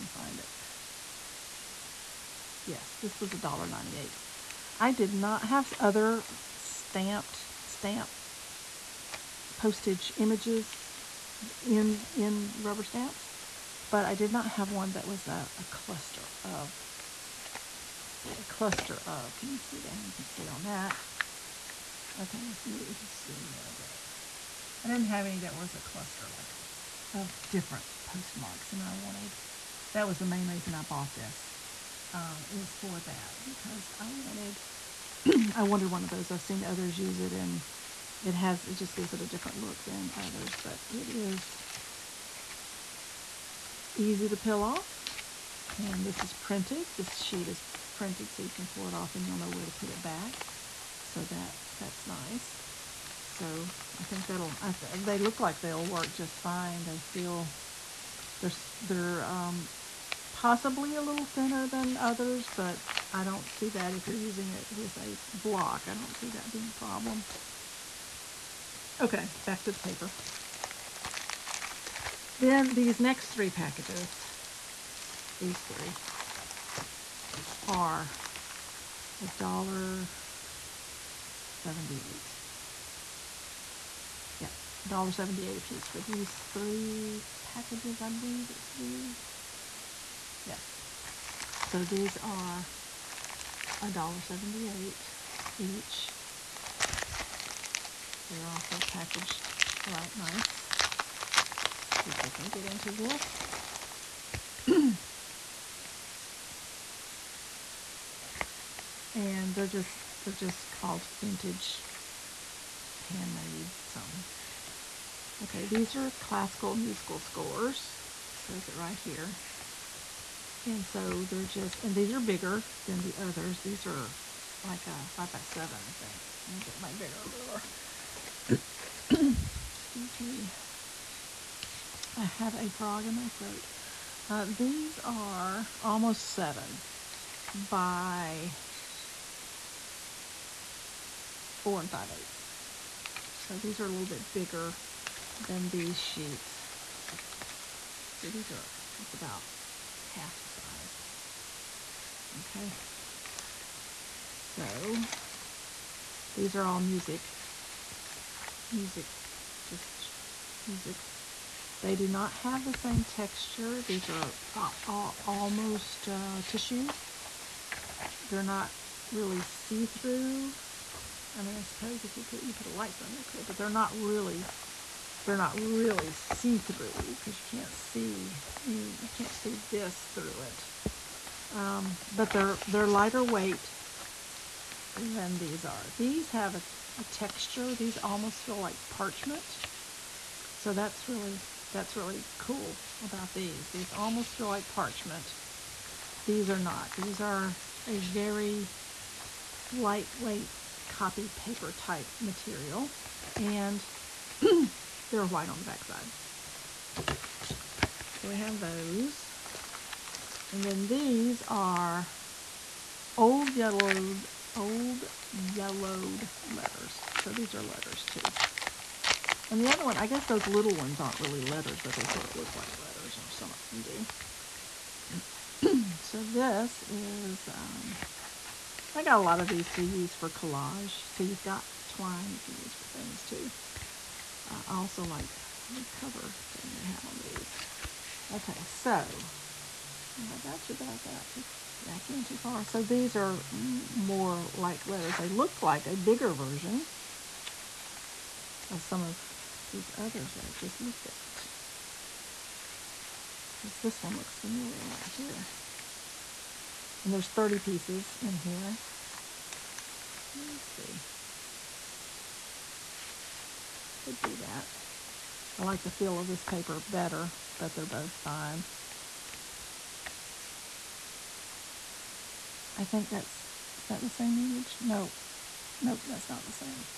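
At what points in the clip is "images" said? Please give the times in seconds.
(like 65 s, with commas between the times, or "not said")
10 s, 274 s.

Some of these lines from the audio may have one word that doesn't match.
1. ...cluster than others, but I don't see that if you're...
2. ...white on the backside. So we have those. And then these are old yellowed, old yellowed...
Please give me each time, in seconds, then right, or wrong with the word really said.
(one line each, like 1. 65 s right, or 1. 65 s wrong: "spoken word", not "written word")
1. 61 s wrong: "thinner", not "cluster"
2. 205 s right.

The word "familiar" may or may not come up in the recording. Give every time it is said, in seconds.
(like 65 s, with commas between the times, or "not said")
254 s.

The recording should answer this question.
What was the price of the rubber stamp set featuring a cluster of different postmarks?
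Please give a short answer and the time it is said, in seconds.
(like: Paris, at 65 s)
$1.98, at 3 s.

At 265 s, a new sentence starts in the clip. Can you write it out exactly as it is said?
I like the feel of this paper better, but they're both fine.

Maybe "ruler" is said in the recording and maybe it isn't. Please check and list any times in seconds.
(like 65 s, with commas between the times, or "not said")
127 s.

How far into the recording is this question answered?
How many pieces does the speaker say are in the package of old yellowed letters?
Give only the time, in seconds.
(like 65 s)
257 s.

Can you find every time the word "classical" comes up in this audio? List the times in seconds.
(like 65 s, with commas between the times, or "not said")
116 s.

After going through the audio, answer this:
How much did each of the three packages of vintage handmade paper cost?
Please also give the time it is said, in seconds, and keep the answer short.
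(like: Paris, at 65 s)
$1.78, at 79 s.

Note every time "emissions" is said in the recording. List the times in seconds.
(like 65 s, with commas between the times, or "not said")
not said.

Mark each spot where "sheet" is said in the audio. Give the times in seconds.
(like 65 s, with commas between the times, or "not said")
47 s, 145 s.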